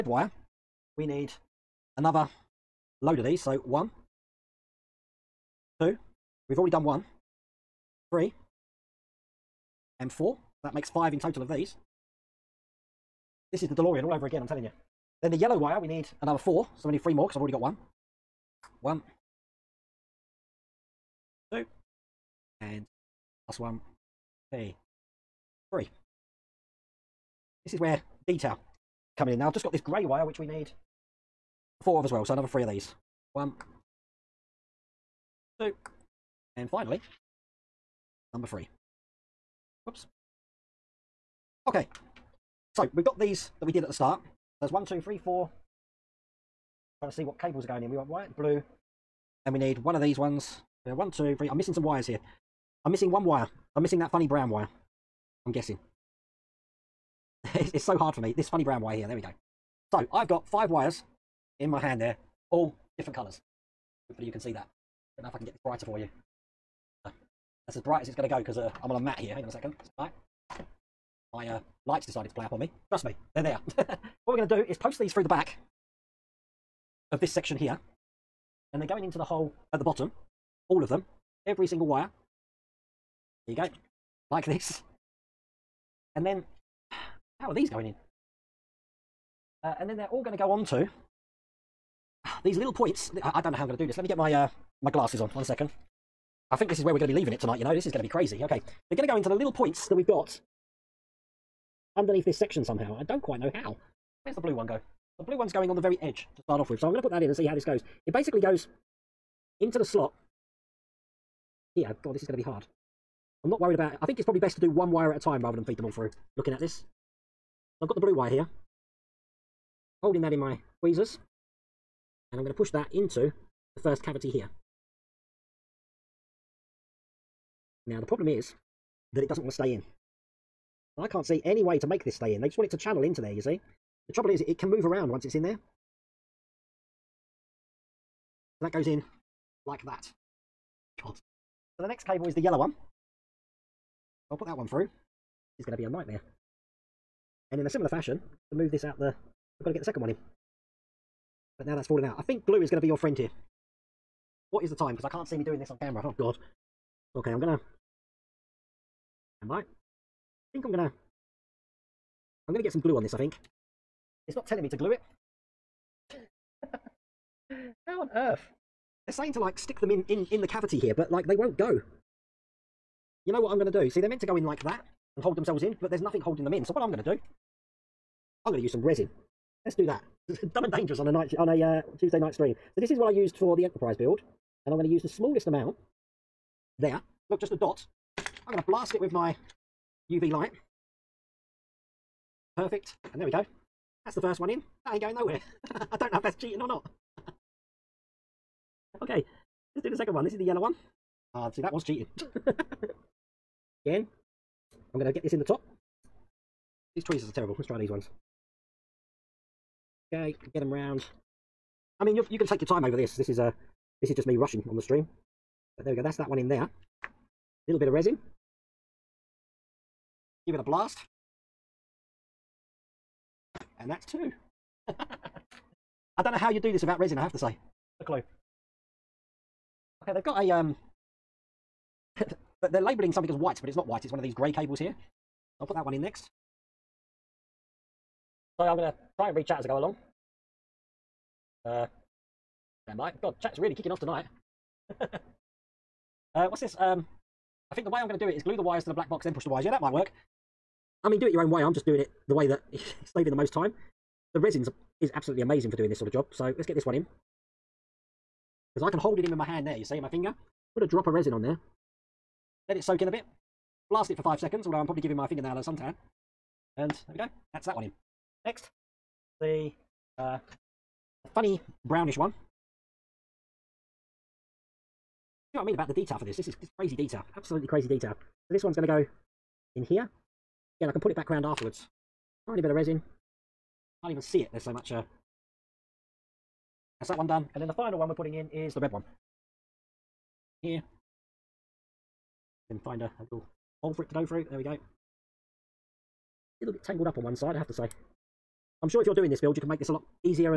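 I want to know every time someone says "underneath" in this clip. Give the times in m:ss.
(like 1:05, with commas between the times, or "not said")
1:41.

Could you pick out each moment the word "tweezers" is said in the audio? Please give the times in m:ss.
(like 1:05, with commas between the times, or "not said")
2:00, 3:27.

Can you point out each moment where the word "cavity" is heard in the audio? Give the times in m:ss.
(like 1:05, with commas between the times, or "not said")
2:04, 2:50.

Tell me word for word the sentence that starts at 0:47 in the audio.
We want white, blue, and we need one of these ones.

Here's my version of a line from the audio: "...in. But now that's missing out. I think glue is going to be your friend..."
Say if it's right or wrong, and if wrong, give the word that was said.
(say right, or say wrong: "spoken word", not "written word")
wrong: "falling", not "missing".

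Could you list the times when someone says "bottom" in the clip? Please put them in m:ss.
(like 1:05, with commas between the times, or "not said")
1:19.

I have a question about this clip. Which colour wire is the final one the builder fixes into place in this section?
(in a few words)
Red.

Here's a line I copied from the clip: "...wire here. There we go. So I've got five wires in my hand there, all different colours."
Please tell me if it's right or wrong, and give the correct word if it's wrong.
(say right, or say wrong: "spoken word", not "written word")
right.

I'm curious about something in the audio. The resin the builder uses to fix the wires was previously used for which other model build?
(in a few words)
Enterprise.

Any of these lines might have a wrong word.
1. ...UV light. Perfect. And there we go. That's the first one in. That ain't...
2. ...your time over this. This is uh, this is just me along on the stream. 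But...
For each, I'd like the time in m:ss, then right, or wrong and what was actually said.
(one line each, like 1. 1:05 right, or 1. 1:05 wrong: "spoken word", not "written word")
1. 3:10 right
2. 3:32 wrong: "rushing", not "along".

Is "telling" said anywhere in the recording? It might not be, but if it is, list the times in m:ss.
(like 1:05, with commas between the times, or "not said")
0:14, 2:44.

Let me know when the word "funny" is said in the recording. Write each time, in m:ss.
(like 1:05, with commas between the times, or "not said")
0:54, 0:58, 4:31.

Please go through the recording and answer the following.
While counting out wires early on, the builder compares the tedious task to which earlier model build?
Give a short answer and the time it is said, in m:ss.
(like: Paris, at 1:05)
DeLorean, at 0:13.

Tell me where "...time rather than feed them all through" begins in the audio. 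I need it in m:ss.
1:55.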